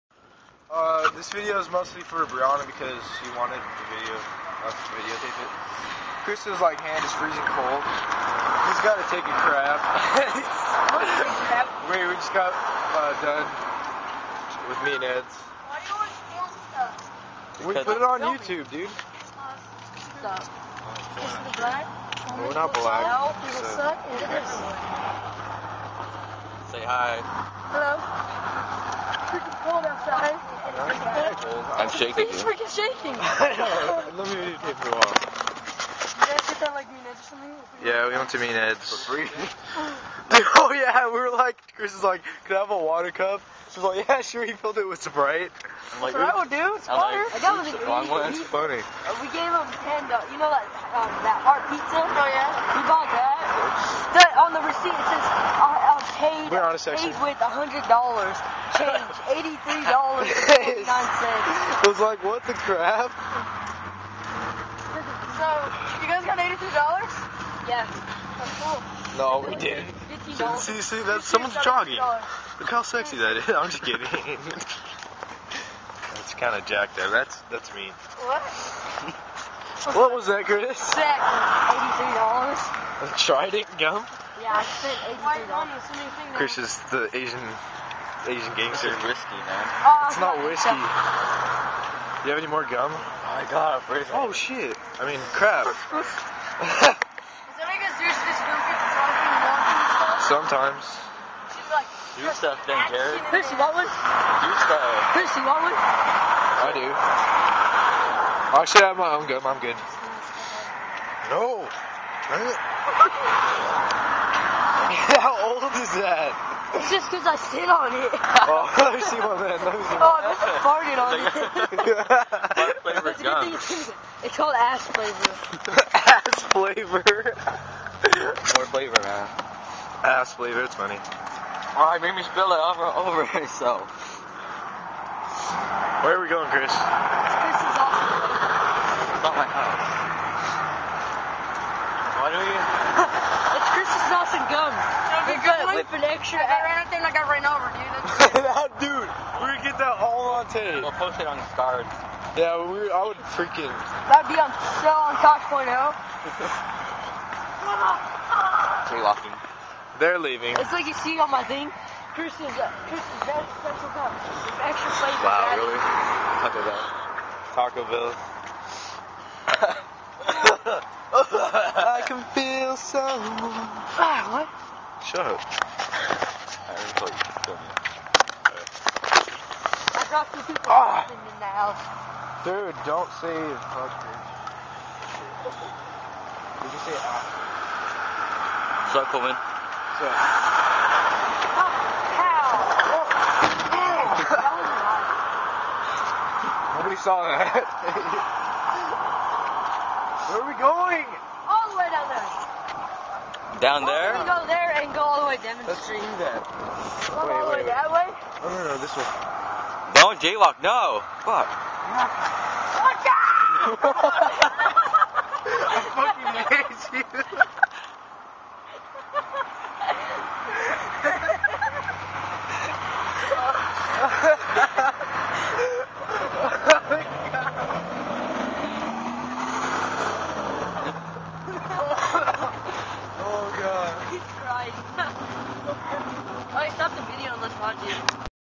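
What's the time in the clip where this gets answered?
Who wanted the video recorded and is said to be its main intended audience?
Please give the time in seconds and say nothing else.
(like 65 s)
2 s.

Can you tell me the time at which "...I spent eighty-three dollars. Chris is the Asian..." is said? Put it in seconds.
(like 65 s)
84 s.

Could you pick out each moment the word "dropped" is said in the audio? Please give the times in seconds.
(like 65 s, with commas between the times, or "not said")
180 s.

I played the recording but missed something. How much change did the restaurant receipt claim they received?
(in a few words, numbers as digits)
$83.49.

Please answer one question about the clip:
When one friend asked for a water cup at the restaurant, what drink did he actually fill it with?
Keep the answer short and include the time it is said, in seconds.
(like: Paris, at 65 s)
Sprite, at 45 s.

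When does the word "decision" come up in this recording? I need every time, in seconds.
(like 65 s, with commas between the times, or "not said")
not said.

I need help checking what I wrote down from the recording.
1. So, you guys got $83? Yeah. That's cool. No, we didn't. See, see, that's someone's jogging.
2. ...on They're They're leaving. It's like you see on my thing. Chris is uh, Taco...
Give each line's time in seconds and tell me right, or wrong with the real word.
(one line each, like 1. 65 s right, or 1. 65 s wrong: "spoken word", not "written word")
1. 65 s right
2. 154 s wrong: "Chris", not "Taco".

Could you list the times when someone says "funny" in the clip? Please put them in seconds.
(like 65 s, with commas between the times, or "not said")
48 s, 130 s.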